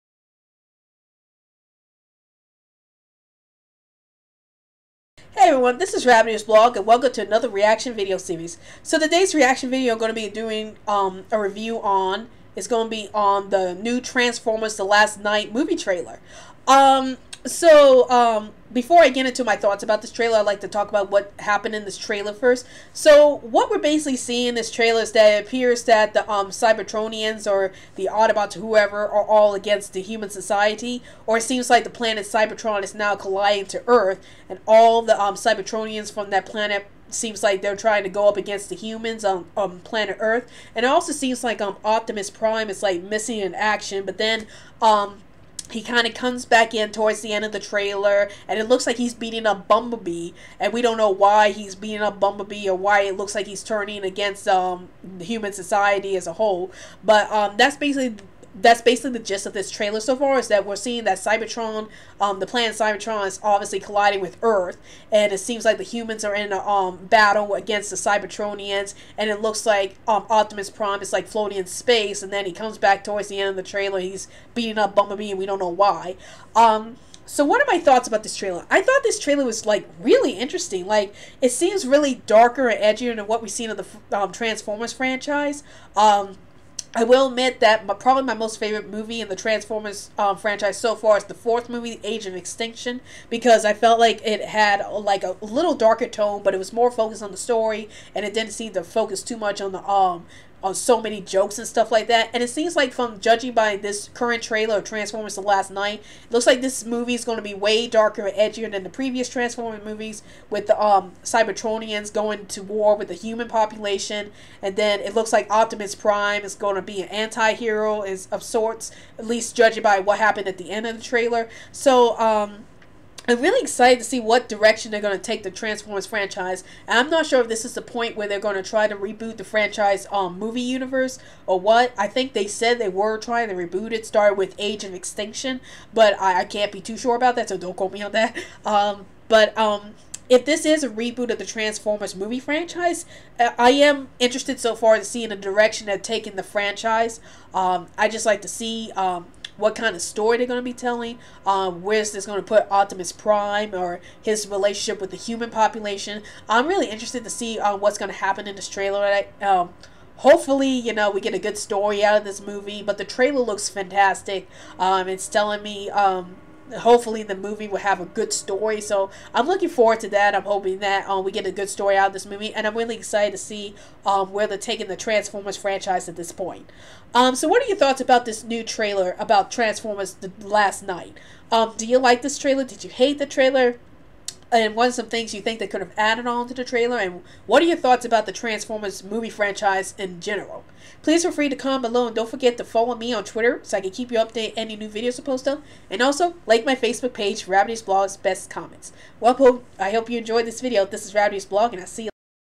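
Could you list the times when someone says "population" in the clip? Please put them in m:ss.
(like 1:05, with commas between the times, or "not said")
1:53, 2:35.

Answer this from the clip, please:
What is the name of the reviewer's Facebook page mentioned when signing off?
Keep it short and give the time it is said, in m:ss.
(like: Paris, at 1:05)
Rabbitearsblog's Best Comments, at 3:17.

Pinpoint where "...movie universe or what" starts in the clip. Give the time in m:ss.
2:10.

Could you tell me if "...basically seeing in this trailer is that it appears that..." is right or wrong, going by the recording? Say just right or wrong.
right.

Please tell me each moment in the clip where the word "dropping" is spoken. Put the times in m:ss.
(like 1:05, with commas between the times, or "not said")
not said.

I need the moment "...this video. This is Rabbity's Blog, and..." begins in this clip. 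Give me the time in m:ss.
3:20.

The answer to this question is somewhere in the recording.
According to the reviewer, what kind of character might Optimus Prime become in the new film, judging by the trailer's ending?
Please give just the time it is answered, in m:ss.
1:57.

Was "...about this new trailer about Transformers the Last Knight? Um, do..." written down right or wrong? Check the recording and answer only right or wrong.
right.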